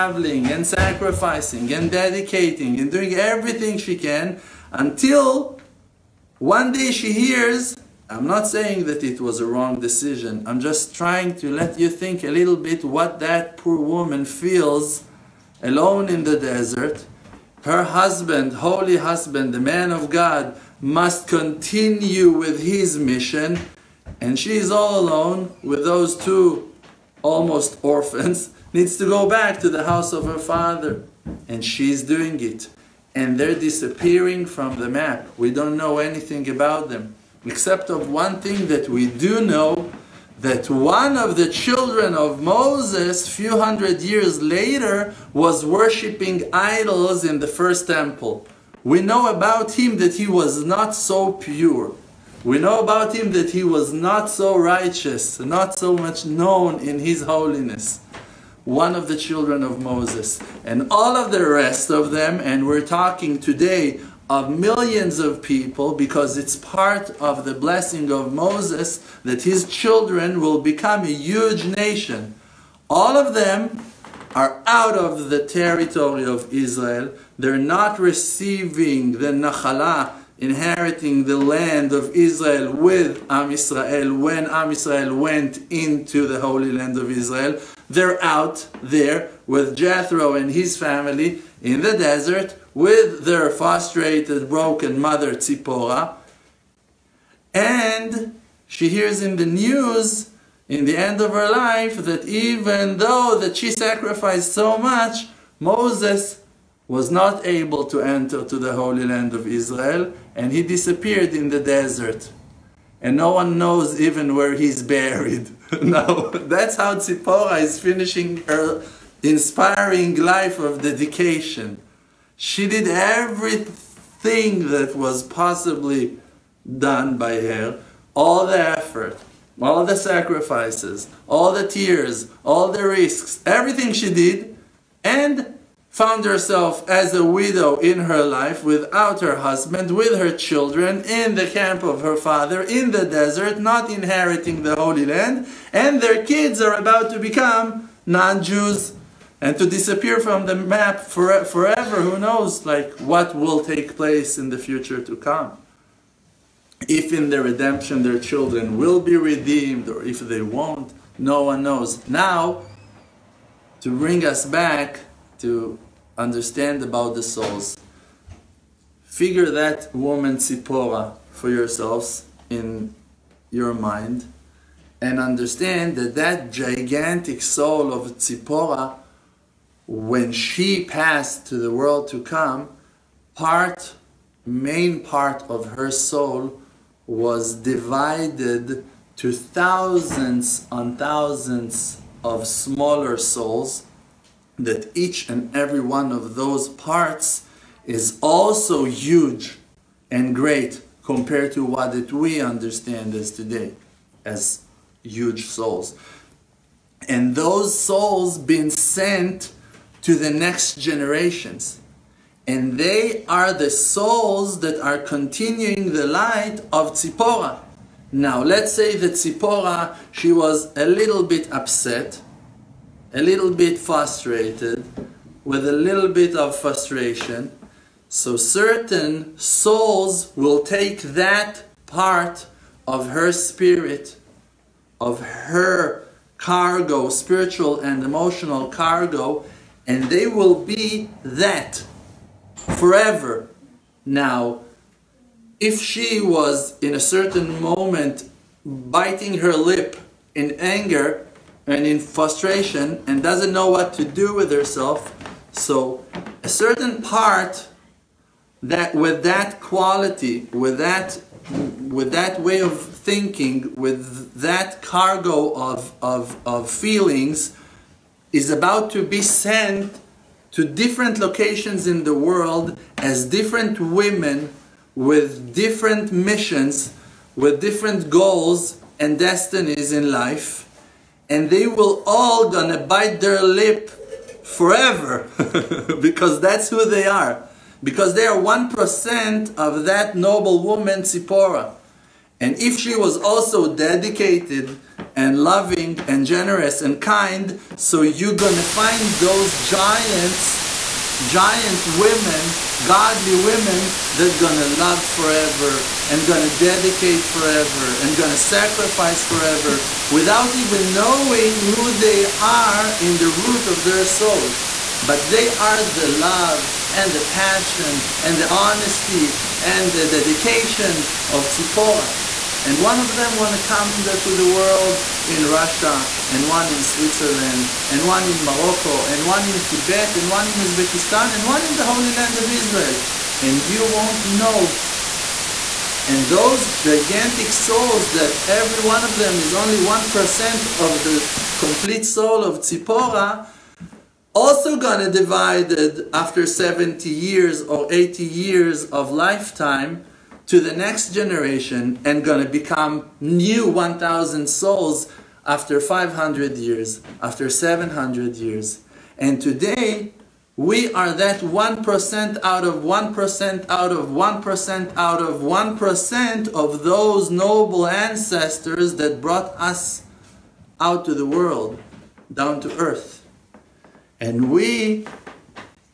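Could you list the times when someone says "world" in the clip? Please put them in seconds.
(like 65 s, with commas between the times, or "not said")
181 s, 272 s, 324 s, 371 s.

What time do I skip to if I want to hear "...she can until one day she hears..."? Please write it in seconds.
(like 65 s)
3 s.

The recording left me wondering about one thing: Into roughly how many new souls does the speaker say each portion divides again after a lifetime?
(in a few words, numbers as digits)
1,000.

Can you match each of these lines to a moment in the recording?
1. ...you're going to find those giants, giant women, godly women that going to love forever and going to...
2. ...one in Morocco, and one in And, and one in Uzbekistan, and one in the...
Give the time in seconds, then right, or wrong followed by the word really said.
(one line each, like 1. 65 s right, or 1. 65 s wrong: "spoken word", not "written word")
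1. 298 s right
2. 328 s wrong: "Tibet", not "And".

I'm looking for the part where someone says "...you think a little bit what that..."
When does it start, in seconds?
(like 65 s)
11 s.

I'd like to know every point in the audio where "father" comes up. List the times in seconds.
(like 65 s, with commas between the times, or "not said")
30 s, 142 s.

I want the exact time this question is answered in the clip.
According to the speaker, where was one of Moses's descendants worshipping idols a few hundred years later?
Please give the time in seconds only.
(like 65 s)
47 s.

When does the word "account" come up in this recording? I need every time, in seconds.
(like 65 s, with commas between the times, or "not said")
not said.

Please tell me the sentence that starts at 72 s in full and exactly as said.
All of them are out of the territory of Israel.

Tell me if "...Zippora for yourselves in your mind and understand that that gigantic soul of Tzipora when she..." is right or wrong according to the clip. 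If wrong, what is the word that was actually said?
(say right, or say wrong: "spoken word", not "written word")
right.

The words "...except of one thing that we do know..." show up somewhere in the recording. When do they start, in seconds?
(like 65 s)
37 s.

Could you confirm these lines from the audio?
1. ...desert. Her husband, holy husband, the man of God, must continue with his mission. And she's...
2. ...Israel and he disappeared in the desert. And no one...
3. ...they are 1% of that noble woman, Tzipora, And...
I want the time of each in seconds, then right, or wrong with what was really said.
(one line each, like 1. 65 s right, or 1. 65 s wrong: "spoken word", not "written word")
1. 16 s right
2. 109 s right
3. 288 s wrong: "Sipora", not "Tzipora".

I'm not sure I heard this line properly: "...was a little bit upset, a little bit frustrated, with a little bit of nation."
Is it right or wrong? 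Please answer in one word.
wrong.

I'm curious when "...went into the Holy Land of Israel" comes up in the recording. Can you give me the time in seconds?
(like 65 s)
85 s.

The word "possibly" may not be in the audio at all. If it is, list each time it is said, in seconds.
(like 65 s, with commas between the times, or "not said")
125 s.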